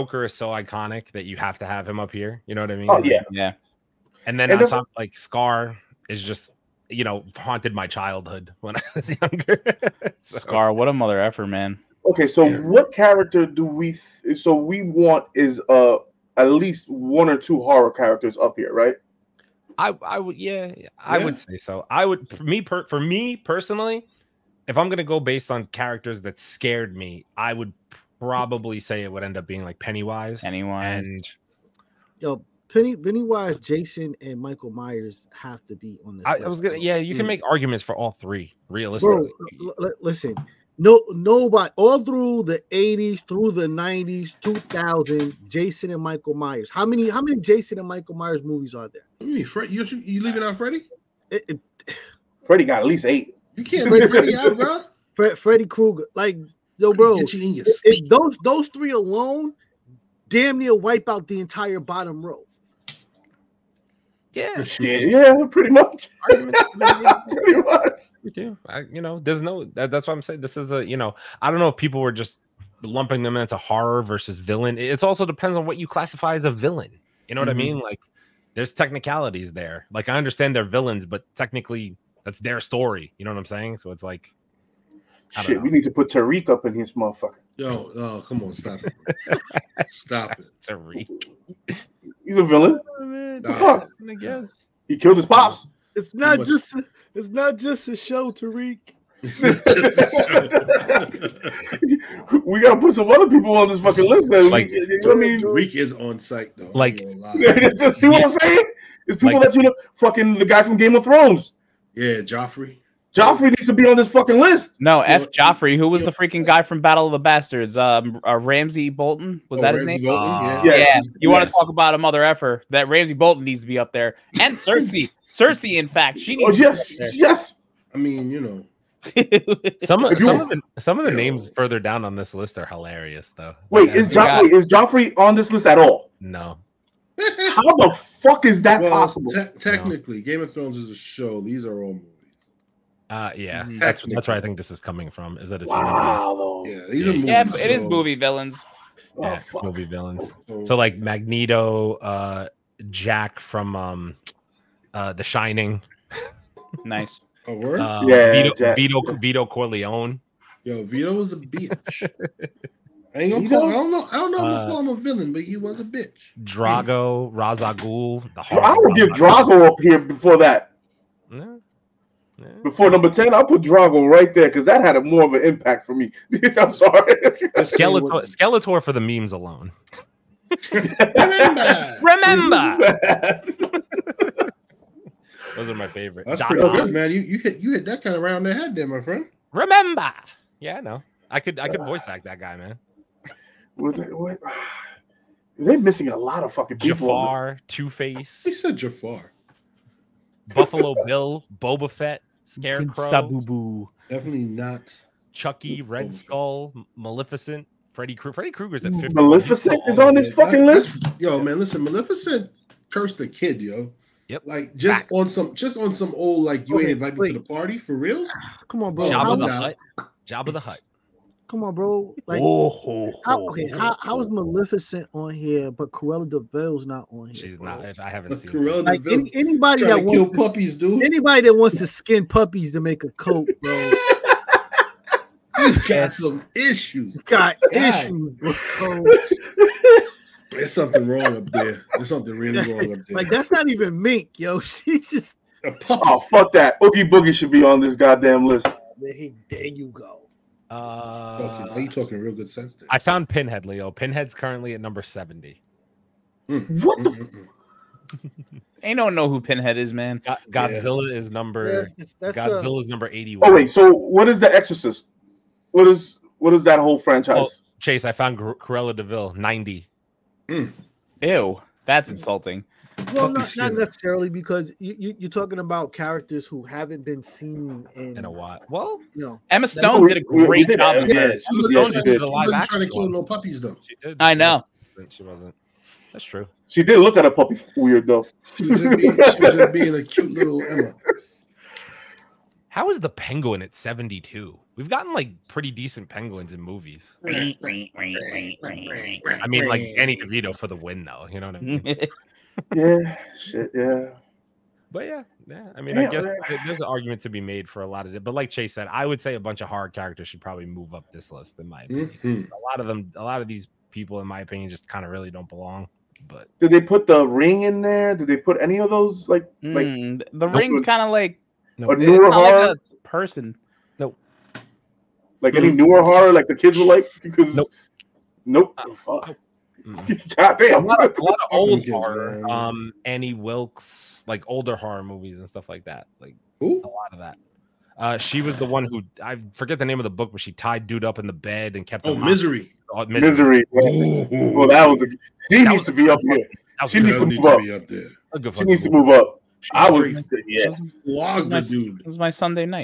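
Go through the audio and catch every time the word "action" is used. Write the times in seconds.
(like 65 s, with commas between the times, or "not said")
282 s.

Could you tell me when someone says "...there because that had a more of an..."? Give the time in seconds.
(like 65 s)
174 s.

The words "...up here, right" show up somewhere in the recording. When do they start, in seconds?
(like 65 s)
18 s.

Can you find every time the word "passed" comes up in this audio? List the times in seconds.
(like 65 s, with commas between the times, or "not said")
not said.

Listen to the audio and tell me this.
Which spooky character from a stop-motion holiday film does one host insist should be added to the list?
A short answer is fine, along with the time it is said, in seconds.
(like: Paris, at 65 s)
Oogie Boogie, at 246 s.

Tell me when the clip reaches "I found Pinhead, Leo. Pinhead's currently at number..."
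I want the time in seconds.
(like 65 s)
252 s.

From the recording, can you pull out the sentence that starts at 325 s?
any newer horror, like the kids were like because nope, nope.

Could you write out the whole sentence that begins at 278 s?
Well, you know, Emma Stone did a great did job.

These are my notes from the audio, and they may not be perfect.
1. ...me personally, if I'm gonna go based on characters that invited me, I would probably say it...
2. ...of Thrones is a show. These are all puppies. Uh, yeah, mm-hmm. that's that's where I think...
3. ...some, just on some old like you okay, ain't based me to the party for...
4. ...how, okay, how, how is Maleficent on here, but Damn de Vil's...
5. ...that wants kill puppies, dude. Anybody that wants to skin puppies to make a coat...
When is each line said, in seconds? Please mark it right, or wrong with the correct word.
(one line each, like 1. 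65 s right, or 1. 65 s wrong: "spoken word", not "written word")
1. 22 s wrong: "scared", not "invited"
2. 140 s wrong: "movies", not "puppies"
3. 215 s wrong: "invited", not "based"
4. 223 s wrong: "Cruella", not "Damn"
5. 229 s right.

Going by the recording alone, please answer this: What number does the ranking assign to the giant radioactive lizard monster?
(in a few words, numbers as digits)
81.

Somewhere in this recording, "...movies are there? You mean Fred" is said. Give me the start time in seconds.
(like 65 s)
48 s.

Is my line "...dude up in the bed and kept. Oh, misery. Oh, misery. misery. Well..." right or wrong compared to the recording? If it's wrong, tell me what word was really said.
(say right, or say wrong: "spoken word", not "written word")
right.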